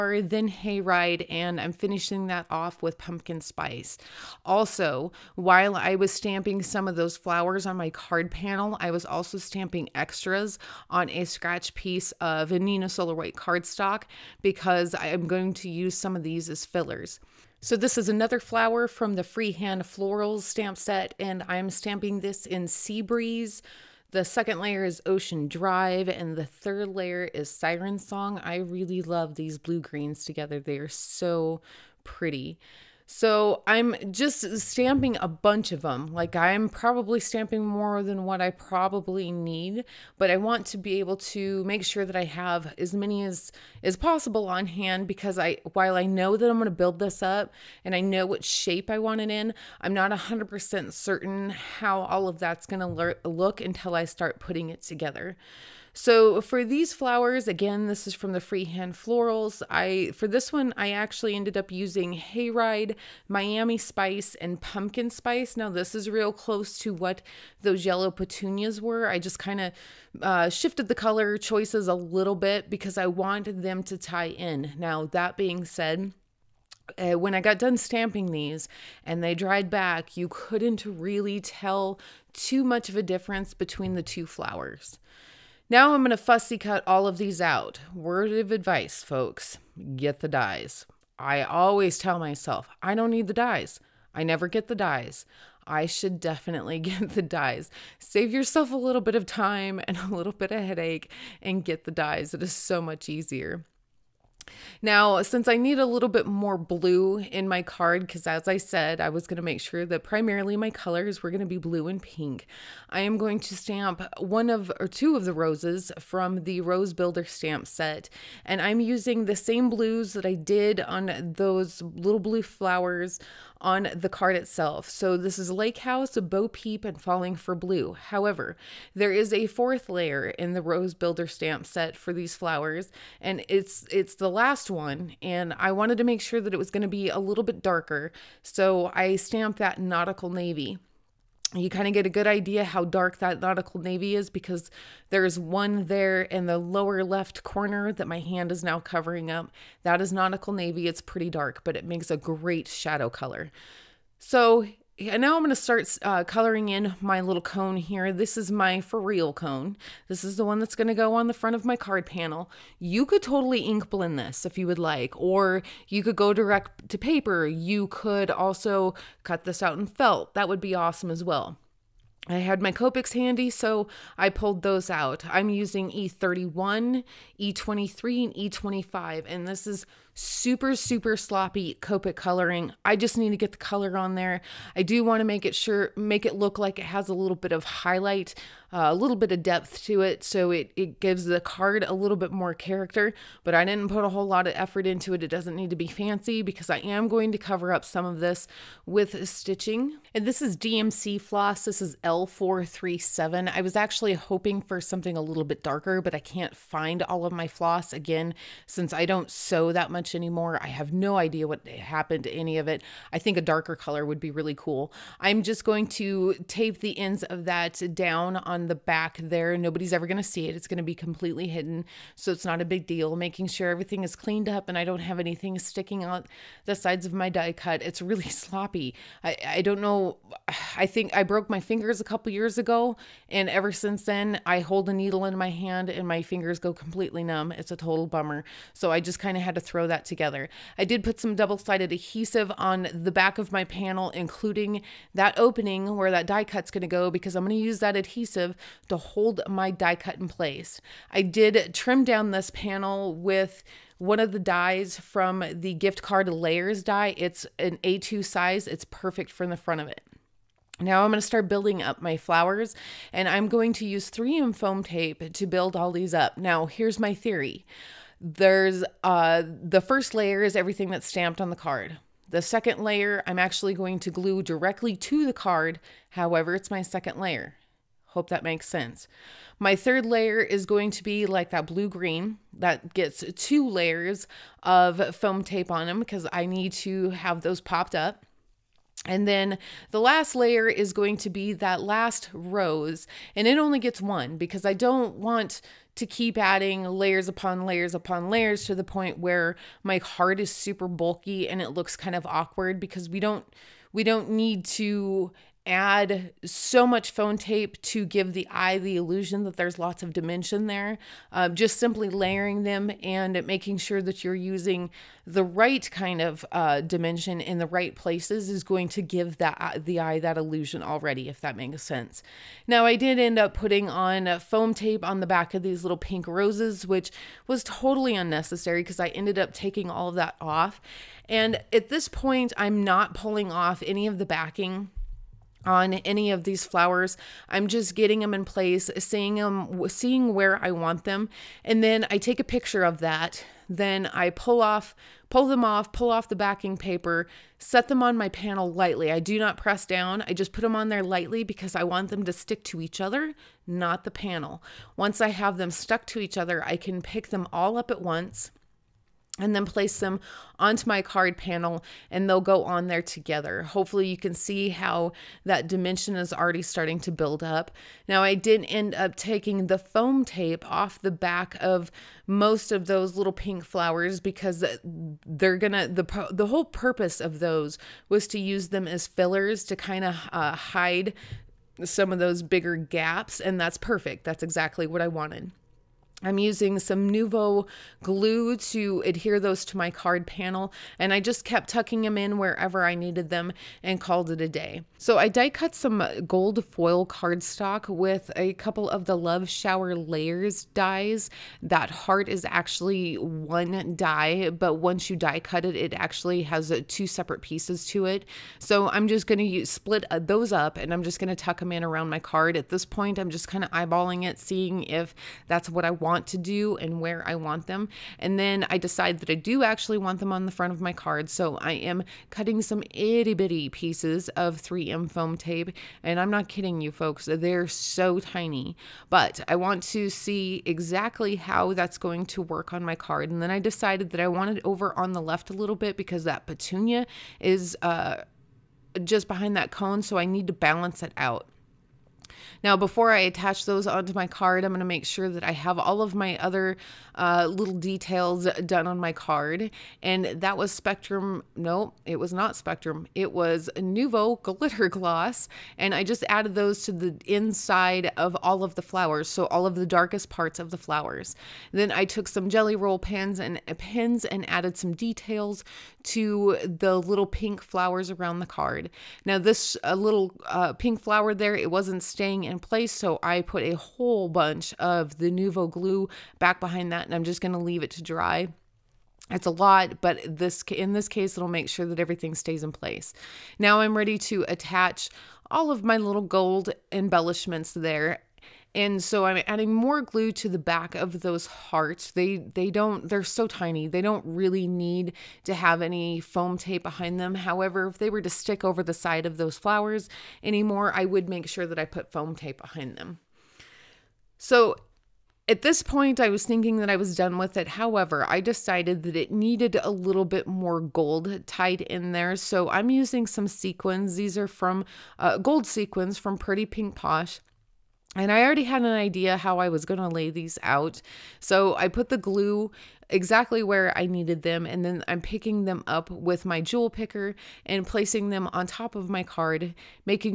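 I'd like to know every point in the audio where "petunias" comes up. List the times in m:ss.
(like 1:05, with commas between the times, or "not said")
1:08, 7:16.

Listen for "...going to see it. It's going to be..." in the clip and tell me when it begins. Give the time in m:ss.
3:40.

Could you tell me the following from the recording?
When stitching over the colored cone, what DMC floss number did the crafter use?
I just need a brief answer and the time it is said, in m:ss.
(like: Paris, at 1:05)
L437, at 3:22.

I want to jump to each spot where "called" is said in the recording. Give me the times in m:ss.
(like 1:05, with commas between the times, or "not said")
6:33.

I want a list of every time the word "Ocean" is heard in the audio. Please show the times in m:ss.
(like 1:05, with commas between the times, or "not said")
0:25.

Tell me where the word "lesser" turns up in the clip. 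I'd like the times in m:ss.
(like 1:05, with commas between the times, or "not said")
not said.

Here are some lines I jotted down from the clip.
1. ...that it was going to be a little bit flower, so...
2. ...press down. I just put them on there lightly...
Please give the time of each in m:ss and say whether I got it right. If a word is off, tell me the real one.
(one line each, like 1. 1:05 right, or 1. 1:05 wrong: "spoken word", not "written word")
1. 2:16 wrong: "darker", not "flower"
2. 5:49 right.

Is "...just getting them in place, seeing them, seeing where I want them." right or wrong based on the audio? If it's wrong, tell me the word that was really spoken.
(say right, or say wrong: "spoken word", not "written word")
right.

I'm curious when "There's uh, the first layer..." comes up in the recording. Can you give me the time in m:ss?
4:28.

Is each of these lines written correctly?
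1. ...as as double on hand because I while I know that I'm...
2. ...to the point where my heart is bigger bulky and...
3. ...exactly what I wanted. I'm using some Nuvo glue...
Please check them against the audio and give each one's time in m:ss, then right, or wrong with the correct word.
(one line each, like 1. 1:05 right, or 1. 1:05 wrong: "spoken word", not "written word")
1. 0:43 wrong: "possible", not "double"
2. 4:58 wrong: "super", not "bigger"
3. 6:24 right.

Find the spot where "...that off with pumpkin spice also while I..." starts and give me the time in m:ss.
0:02.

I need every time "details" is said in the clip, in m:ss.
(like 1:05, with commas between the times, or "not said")
7:27, 7:44.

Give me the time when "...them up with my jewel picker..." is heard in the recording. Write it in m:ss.
8:45.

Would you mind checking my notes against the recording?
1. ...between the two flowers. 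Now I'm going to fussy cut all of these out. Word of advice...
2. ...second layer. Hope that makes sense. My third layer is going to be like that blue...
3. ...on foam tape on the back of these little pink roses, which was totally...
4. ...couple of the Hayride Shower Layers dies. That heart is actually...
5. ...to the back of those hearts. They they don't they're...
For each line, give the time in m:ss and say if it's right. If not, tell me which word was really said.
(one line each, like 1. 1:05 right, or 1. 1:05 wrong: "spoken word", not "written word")
1. 1:23 right
2. 4:36 right
3. 5:23 right
4. 6:38 wrong: "Love", not "Hayride"
5. 8:10 right.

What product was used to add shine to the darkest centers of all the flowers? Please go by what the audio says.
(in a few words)
Nuvo Glitter Gloss.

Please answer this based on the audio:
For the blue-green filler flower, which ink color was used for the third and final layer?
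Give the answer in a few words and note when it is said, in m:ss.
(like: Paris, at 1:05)
Siren Song, at 0:27.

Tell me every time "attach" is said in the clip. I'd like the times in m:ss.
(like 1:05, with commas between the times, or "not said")
7:23, 8:04.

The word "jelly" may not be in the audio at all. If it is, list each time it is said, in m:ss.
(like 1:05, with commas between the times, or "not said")
7:42.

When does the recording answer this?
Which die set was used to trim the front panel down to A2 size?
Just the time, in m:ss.
4:15.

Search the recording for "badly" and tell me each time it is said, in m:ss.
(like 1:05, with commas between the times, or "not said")
not said.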